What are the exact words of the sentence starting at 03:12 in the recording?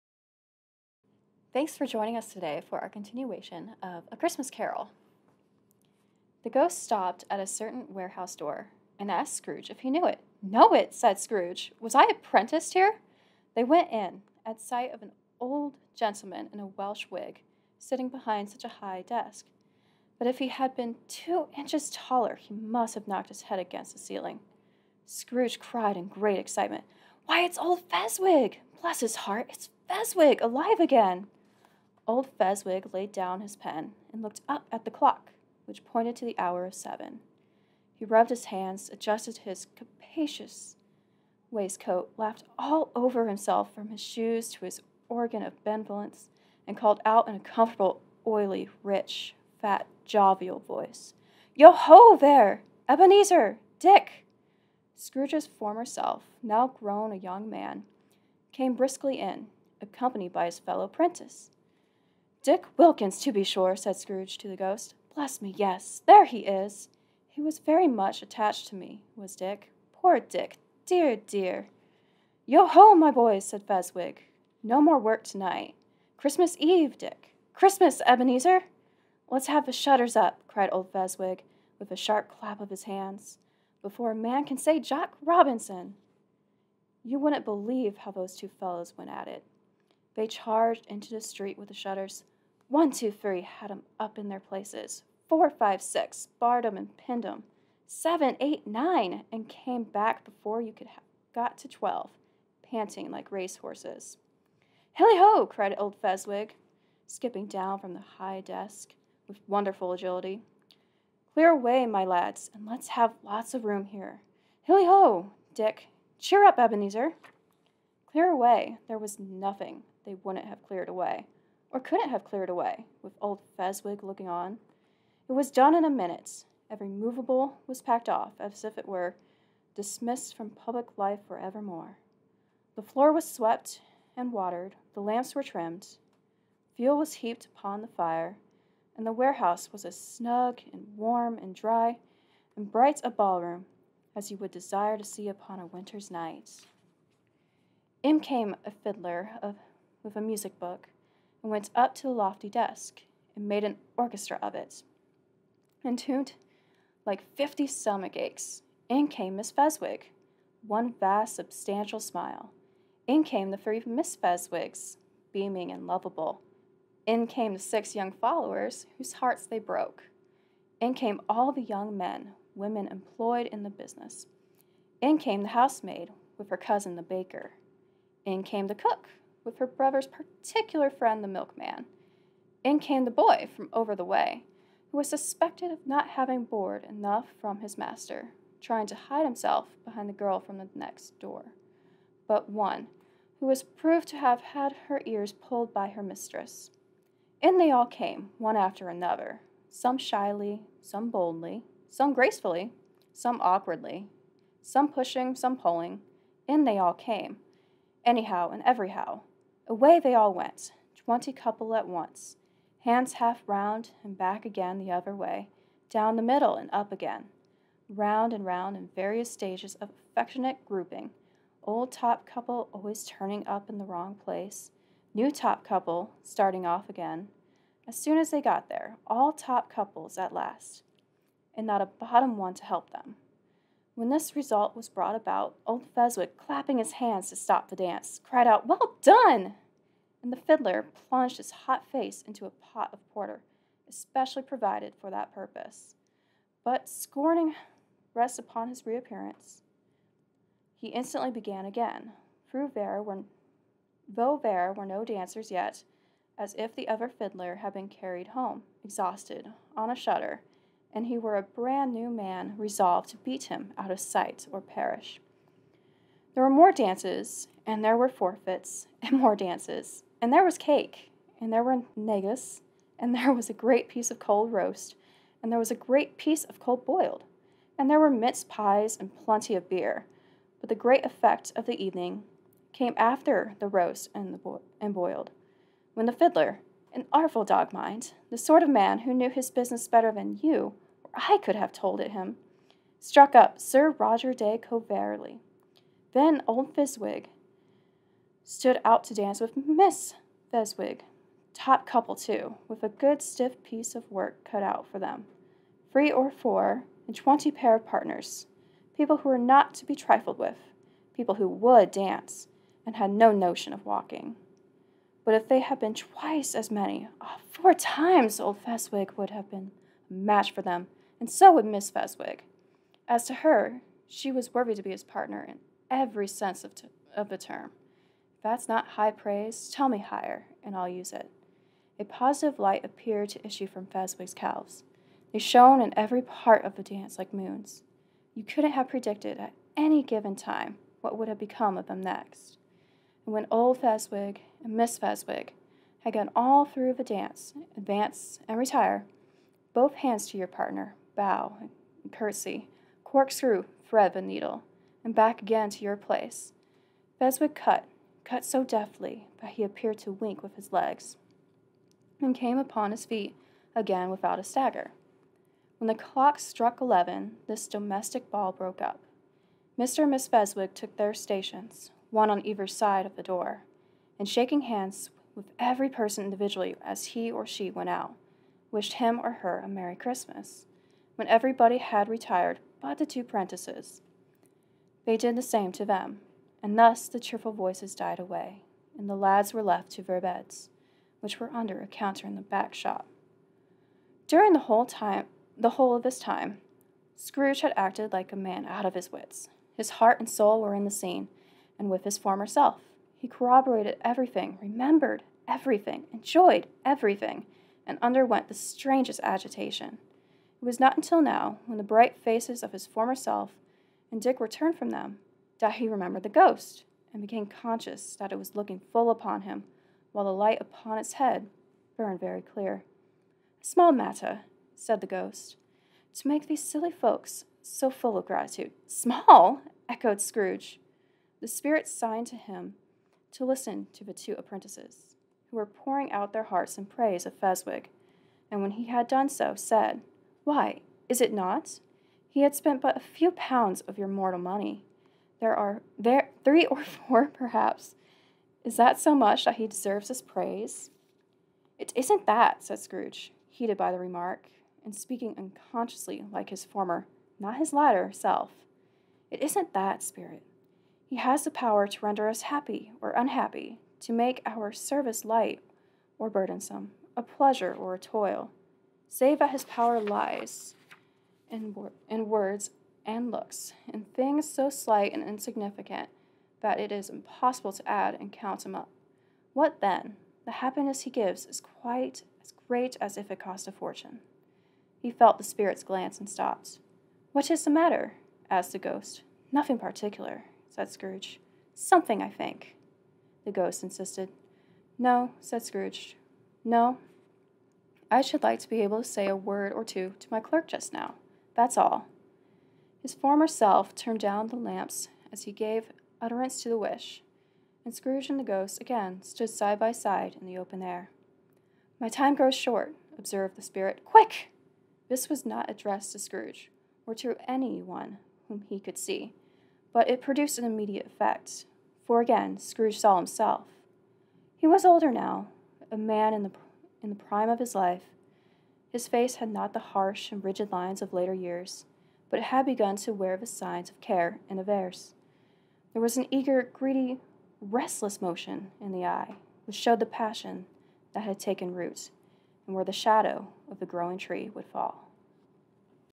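But one, who was proved to have had her ears pulled by her mistress.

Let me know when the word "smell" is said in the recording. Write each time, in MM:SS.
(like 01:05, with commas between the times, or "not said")
not said.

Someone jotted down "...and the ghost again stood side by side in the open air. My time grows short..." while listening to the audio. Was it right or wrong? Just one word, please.
right.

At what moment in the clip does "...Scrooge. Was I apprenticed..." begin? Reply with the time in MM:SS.
00:11.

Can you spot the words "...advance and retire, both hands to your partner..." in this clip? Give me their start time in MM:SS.
05:47.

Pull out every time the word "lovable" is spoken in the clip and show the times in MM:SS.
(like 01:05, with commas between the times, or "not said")
02:45.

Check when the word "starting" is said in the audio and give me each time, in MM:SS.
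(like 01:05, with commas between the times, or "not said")
03:46.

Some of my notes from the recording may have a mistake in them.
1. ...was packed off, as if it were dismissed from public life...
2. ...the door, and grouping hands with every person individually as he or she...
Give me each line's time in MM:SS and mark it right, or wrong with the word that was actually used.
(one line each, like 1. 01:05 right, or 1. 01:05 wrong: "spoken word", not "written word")
1. 02:07 right
2. 06:13 wrong: "shaking", not "grouping".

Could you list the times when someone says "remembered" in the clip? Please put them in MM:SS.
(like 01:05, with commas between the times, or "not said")
06:44, 06:55.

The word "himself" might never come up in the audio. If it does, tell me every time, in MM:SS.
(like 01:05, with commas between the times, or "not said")
00:43, 03:09, 08:43.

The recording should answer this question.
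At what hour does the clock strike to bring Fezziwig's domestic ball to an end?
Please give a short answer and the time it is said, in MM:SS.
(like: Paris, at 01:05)
11, at 06:06.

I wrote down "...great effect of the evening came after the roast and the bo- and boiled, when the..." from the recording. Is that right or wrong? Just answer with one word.
right.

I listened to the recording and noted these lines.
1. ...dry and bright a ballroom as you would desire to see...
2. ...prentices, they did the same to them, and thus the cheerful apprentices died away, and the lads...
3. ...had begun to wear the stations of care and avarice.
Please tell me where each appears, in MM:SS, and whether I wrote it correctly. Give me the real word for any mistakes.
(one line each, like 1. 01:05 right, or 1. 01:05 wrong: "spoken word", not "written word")
1. 02:21 right
2. 06:23 wrong: "voices", not "apprentices"
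3. 08:52 wrong: "signs", not "stations".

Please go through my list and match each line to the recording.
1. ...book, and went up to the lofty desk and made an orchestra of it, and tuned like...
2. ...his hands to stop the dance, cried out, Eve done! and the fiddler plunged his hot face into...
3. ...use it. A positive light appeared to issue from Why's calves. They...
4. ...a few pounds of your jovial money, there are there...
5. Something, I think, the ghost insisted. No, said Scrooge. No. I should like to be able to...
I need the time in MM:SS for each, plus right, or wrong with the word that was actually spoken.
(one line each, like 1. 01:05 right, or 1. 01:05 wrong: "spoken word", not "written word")
1. 02:30 right
2. 03:56 wrong: "Well", not "Eve"
3. 05:30 wrong: "Fezziwig", not "Why"
4. 07:22 wrong: "mortal", not "jovial"
5. 08:11 right.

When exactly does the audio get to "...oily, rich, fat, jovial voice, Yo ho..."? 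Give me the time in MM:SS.
00:48.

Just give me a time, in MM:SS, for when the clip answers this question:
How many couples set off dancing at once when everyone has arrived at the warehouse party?
03:30.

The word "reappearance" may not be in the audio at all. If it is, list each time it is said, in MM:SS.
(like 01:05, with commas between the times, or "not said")
04:08.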